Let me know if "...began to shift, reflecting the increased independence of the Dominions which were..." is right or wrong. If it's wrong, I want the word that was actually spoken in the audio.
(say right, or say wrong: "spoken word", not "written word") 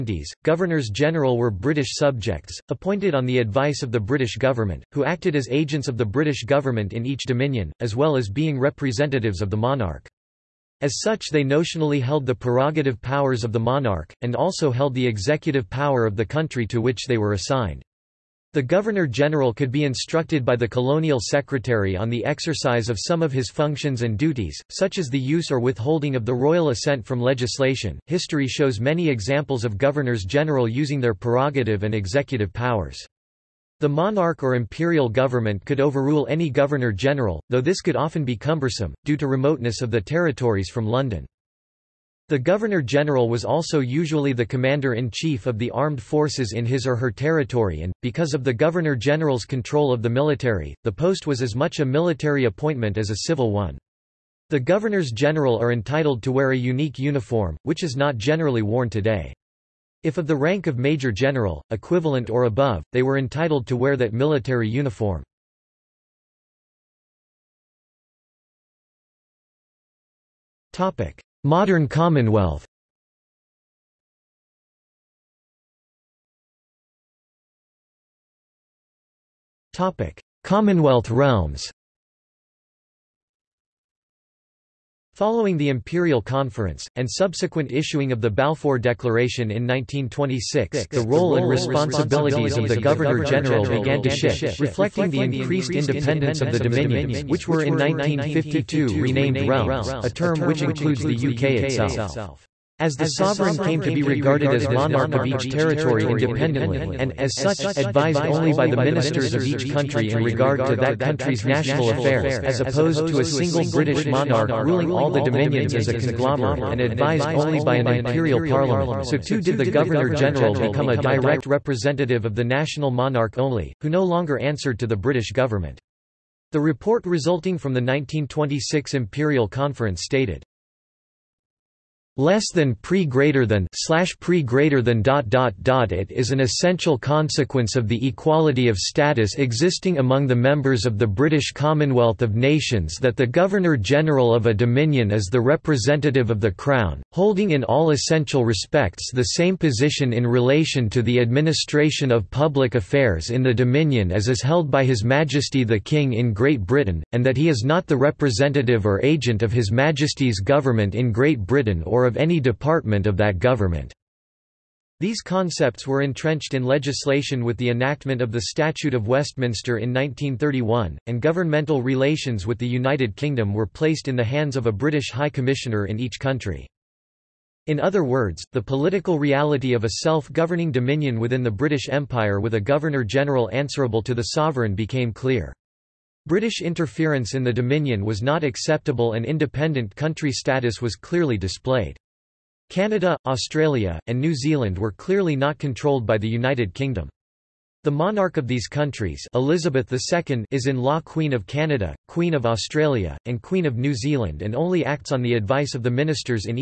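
right.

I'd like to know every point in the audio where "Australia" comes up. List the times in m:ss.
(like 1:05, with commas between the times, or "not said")
3:13, 3:22.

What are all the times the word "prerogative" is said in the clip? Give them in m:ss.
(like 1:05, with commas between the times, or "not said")
0:12, 0:31.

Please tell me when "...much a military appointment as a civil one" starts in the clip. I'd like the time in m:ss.
0:51.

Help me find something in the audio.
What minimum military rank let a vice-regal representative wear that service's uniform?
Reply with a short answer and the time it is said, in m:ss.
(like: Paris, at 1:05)
Major General, at 1:00.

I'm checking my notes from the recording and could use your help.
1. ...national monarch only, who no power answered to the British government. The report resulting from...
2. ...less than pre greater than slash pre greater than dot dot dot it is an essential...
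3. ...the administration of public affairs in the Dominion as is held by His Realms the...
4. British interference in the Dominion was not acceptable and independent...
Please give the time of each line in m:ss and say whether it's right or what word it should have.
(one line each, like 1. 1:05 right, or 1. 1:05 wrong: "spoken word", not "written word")
1. 2:02 wrong: "longer", not "power"
2. 2:12 right
3. 2:31 wrong: "Majesty", not "Realms"
4. 3:06 right.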